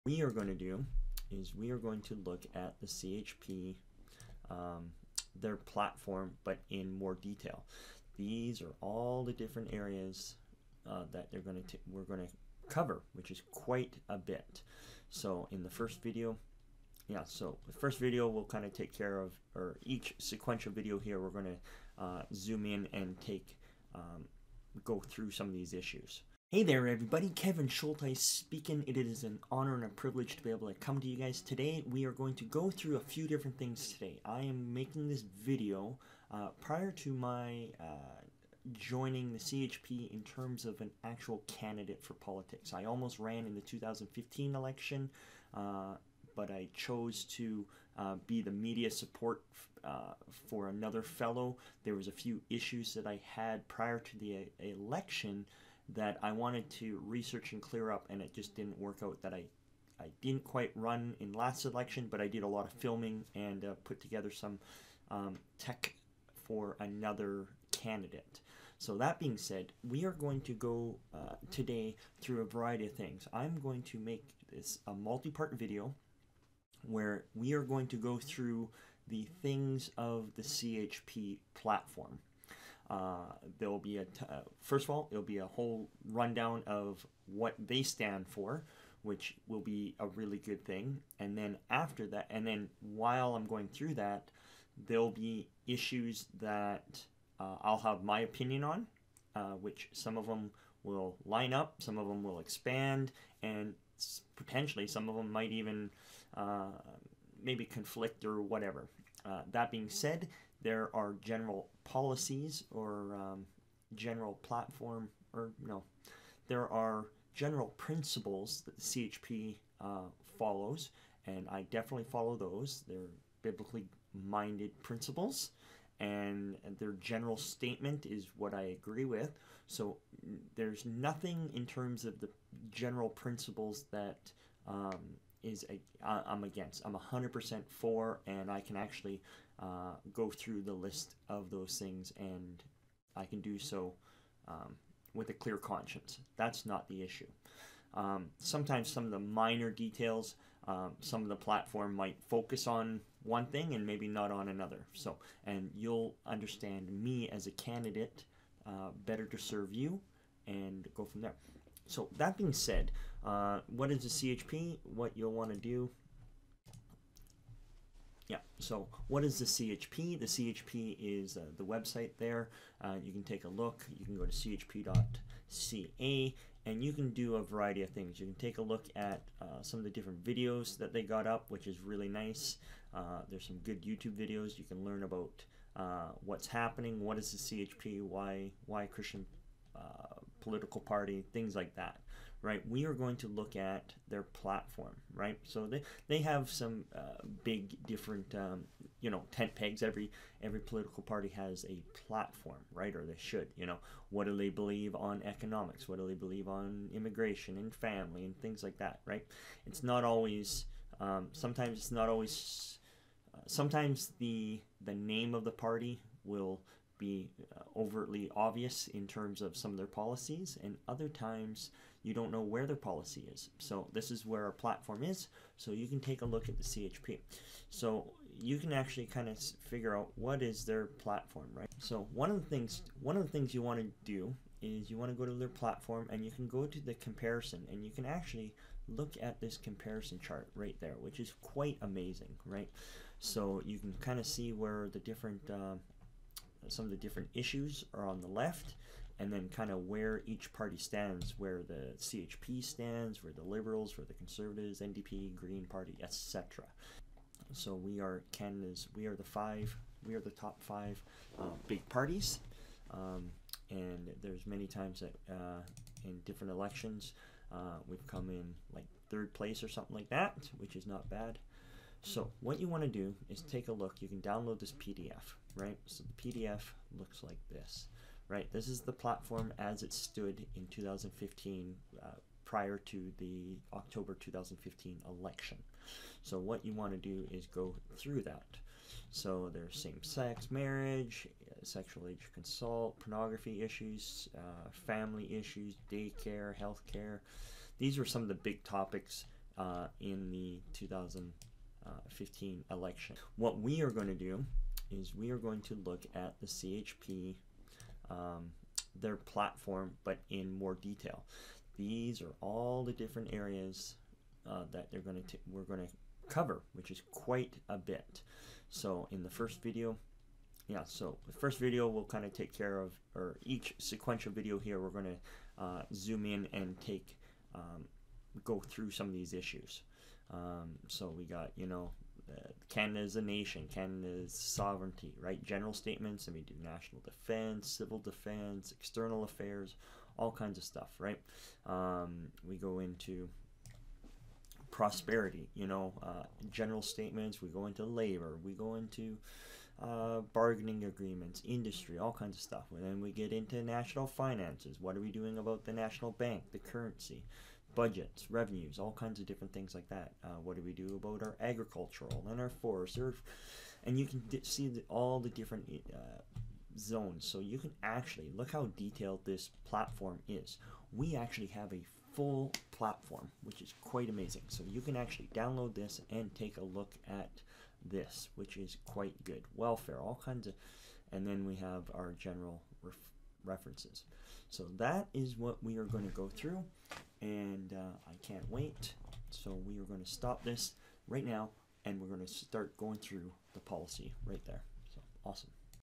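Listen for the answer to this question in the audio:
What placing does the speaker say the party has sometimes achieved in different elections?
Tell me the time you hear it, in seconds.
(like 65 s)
269 s.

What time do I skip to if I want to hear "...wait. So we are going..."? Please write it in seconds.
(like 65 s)
388 s.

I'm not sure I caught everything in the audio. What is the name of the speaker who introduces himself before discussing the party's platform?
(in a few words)
Kevin Schulthies.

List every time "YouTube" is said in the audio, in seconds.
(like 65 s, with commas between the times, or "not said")
183 s.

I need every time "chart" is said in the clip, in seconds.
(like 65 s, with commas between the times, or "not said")
240 s.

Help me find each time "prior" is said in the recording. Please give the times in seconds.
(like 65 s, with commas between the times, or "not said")
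36 s, 53 s, 282 s.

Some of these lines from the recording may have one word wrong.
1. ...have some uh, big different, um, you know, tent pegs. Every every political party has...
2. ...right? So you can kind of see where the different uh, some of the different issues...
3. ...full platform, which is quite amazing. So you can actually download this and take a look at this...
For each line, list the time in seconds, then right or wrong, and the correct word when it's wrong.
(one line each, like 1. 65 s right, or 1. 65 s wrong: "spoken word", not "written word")
1. 196 s right
2. 242 s right
3. 372 s right.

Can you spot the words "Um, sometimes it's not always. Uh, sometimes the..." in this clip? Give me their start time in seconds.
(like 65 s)
210 s.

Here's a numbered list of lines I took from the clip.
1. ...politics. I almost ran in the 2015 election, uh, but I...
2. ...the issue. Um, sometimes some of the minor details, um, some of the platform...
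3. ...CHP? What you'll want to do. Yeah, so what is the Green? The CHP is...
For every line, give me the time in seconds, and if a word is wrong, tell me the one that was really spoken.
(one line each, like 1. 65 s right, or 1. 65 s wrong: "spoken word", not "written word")
1. 42 s right
2. 146 s right
3. 164 s wrong: "CHP", not "Green".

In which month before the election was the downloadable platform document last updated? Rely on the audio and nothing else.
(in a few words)
October.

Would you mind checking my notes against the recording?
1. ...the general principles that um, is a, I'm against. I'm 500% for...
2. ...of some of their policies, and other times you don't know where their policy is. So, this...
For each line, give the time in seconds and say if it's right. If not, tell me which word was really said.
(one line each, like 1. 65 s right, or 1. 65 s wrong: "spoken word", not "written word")
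1. 132 s wrong: "100", not "500"
2. 219 s right.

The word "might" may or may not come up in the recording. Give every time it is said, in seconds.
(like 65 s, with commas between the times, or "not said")
105 s, 151 s.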